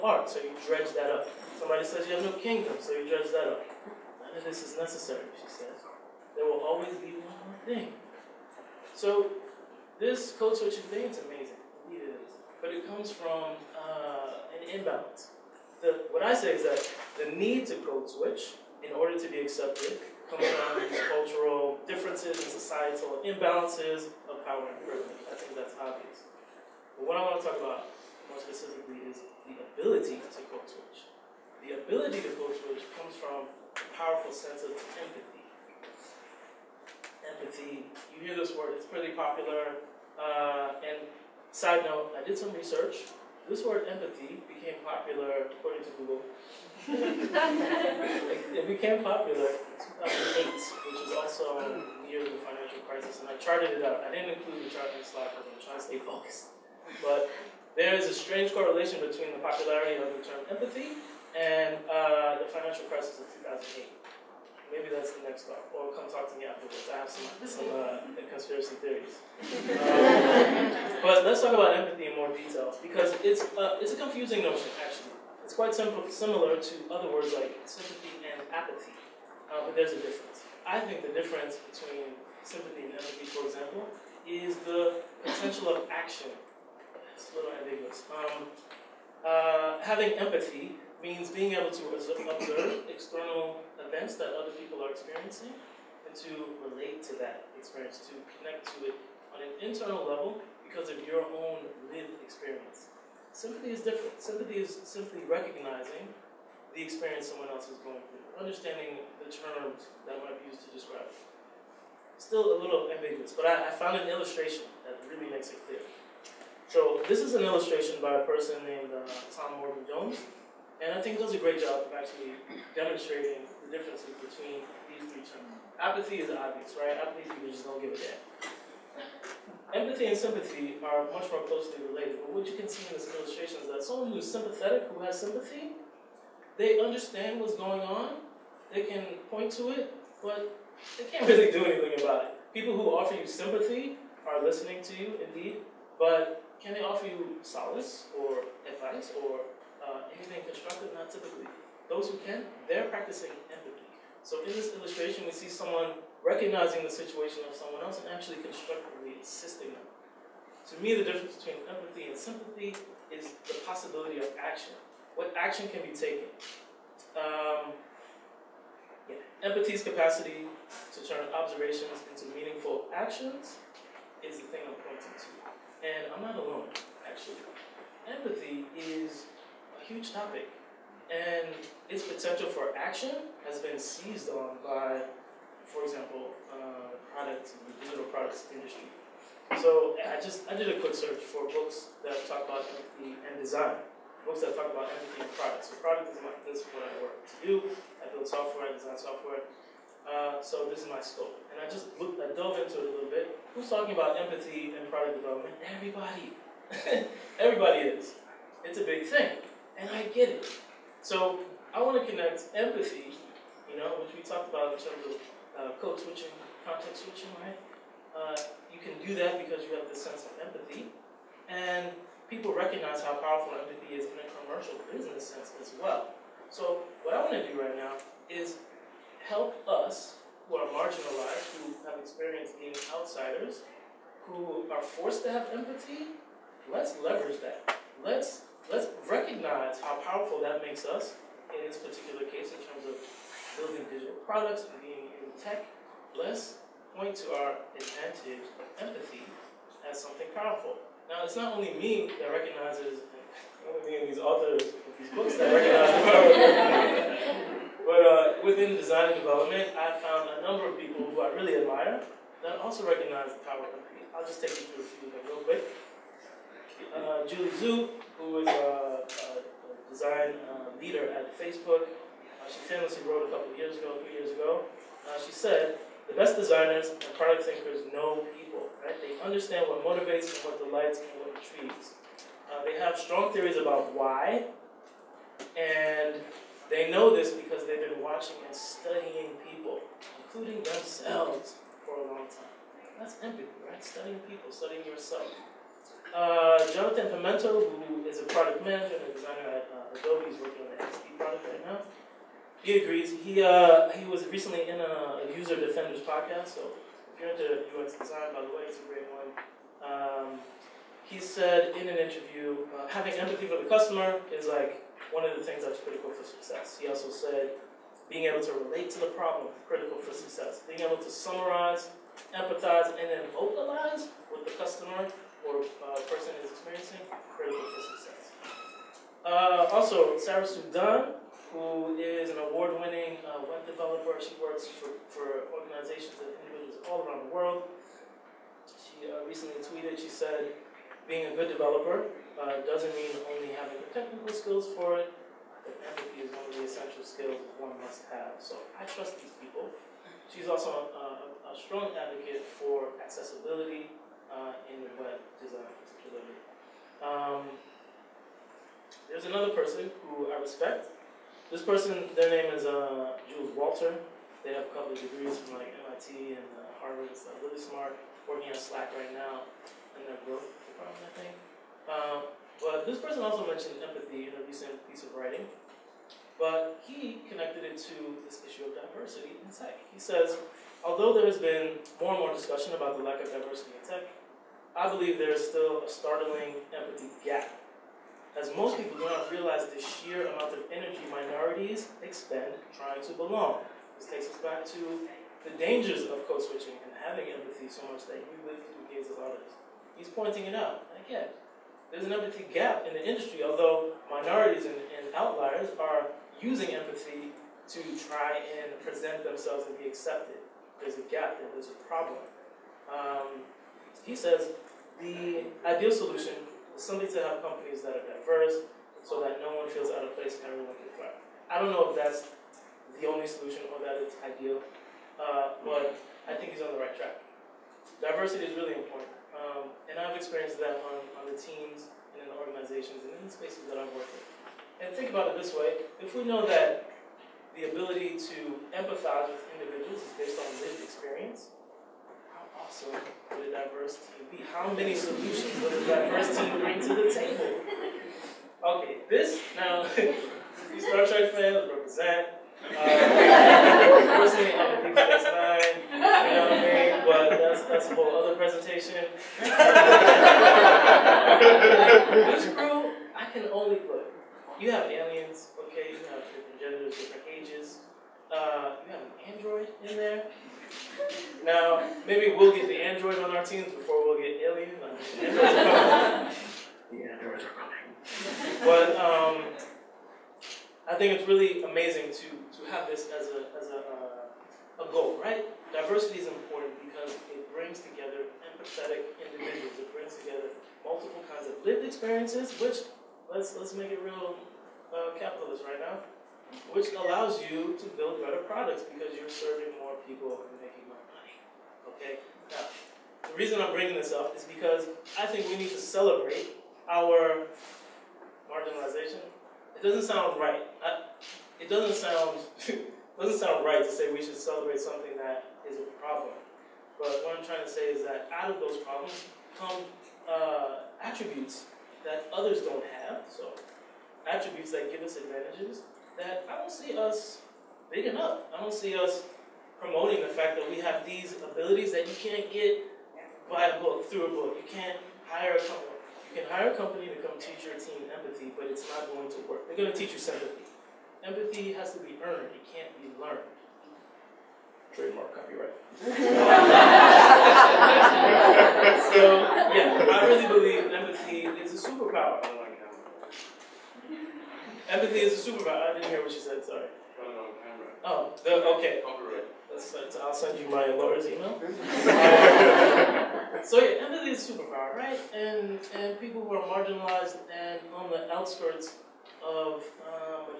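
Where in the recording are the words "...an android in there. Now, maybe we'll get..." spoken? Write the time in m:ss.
7:49.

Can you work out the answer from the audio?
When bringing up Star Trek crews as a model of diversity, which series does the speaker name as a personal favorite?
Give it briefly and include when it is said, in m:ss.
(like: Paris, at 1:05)
Deep Space Nine, at 7:34.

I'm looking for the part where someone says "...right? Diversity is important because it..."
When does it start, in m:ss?
8:05.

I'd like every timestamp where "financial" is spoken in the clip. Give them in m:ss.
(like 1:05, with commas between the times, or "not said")
0:52, 1:02.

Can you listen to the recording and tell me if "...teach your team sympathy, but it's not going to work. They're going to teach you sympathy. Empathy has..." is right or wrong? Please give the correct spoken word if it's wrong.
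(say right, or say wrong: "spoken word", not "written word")
wrong: "empathy", not "sympathy".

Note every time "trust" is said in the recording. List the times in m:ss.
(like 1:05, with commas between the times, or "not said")
5:48.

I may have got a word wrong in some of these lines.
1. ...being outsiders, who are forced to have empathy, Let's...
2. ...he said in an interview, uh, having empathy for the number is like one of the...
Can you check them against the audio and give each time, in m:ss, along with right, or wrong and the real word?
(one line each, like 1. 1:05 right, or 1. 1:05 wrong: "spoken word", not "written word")
1. 3:52 right
2. 5:11 wrong: "customer", not "number".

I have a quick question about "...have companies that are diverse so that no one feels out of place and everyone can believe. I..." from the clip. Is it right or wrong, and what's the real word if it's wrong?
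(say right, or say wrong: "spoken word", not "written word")
wrong: "thrive", not "believe".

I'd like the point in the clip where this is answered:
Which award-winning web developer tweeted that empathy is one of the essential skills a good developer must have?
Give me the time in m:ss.
5:30.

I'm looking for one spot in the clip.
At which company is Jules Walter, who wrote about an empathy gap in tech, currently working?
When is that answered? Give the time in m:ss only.
6:08.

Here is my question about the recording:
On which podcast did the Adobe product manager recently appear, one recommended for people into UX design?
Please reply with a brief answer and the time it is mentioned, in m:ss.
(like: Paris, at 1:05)
User Defenders, at 5:05.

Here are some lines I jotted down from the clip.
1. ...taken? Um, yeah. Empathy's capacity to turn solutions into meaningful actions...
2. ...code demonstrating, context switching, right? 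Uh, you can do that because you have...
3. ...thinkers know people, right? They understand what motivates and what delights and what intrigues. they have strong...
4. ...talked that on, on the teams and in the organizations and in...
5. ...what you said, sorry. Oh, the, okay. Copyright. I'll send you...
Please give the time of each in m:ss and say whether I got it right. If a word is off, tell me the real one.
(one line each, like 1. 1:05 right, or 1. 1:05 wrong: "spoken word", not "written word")
1. 2:45 wrong: "observations", not "solutions"
2. 3:35 wrong: "switching", not "demonstrating"
3. 4:37 right
4. 7:10 wrong: "experienced", not "talked"
5. 9:16 right.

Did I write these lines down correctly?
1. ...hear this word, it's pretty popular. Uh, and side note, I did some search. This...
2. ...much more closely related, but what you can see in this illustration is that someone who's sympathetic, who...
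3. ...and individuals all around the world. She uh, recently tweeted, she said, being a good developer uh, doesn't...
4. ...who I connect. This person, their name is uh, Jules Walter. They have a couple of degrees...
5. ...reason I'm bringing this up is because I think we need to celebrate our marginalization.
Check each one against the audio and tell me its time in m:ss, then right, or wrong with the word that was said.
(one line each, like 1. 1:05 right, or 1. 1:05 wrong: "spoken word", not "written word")
1. 0:38 wrong: "research", not "search"
2. 2:11 right
3. 5:36 right
4. 6:00 wrong: "respect", not "connect"
5. 8:23 right.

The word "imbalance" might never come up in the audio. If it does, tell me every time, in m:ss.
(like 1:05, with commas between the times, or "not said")
0:14, 0:23.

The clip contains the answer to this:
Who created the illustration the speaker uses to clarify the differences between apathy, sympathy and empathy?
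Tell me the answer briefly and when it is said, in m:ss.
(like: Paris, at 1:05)
Tom Morgan Jones, at 1:59.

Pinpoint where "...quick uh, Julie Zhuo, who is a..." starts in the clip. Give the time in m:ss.
4:25.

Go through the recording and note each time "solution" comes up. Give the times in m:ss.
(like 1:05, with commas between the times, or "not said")
6:55, 7:03, 7:24.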